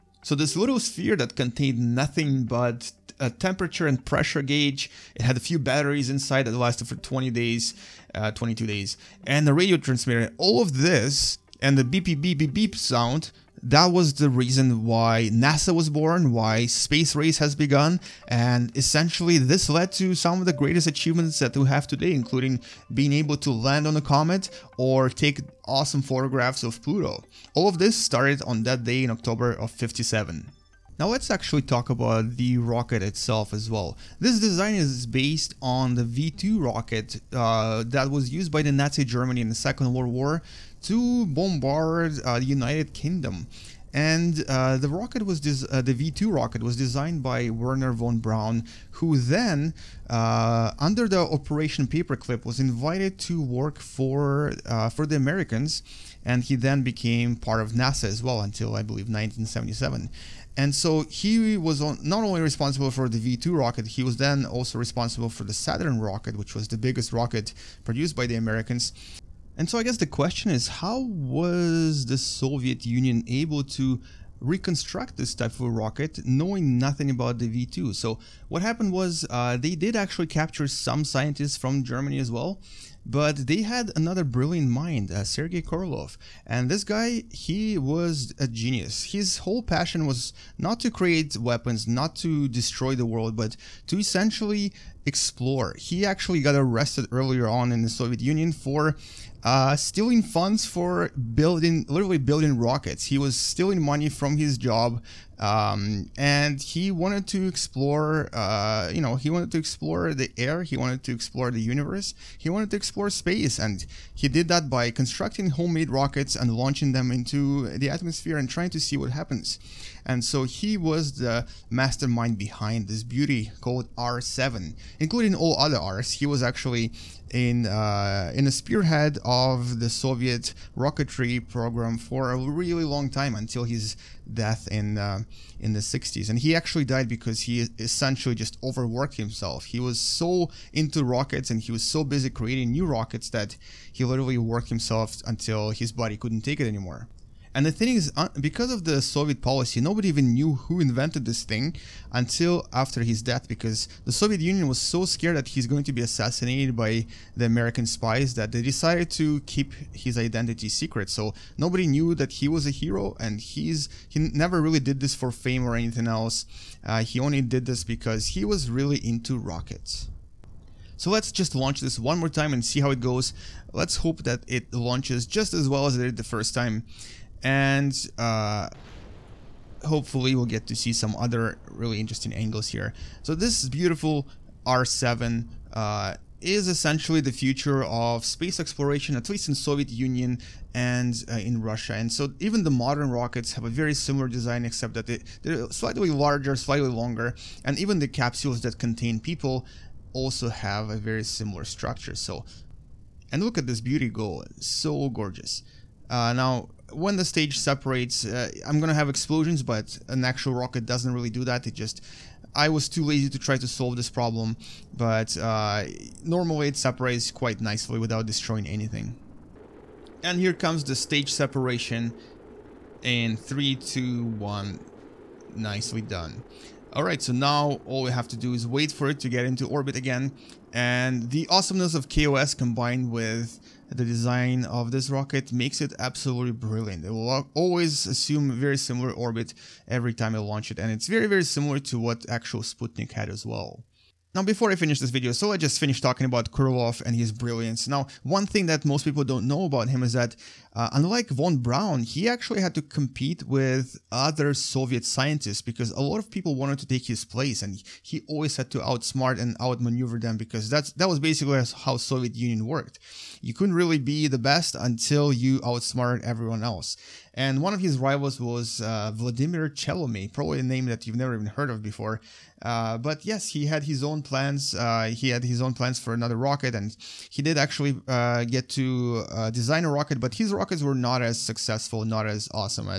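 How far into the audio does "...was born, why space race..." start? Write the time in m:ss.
0:15.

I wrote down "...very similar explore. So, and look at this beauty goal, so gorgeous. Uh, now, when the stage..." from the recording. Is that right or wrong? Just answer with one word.
wrong.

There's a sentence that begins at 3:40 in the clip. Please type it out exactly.
And here comes the stage separation in 3, 2, 1, nicely done.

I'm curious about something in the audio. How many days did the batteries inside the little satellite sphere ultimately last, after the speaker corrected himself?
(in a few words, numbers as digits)
22 days.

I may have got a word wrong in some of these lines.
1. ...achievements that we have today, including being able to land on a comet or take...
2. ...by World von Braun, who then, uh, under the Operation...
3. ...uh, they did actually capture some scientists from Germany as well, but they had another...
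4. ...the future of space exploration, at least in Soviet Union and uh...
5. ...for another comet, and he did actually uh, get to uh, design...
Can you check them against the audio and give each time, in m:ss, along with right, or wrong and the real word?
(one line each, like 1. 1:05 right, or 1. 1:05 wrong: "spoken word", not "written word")
1. 0:20 right
2. 0:47 wrong: "Wernher", not "World"
3. 1:19 right
4. 3:07 right
5. 4:35 wrong: "rocket", not "comet".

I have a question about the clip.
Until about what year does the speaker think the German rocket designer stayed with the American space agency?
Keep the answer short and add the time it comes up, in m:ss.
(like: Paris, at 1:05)
1977, at 0:59.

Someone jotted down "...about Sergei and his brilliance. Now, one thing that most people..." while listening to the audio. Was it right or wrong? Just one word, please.
wrong.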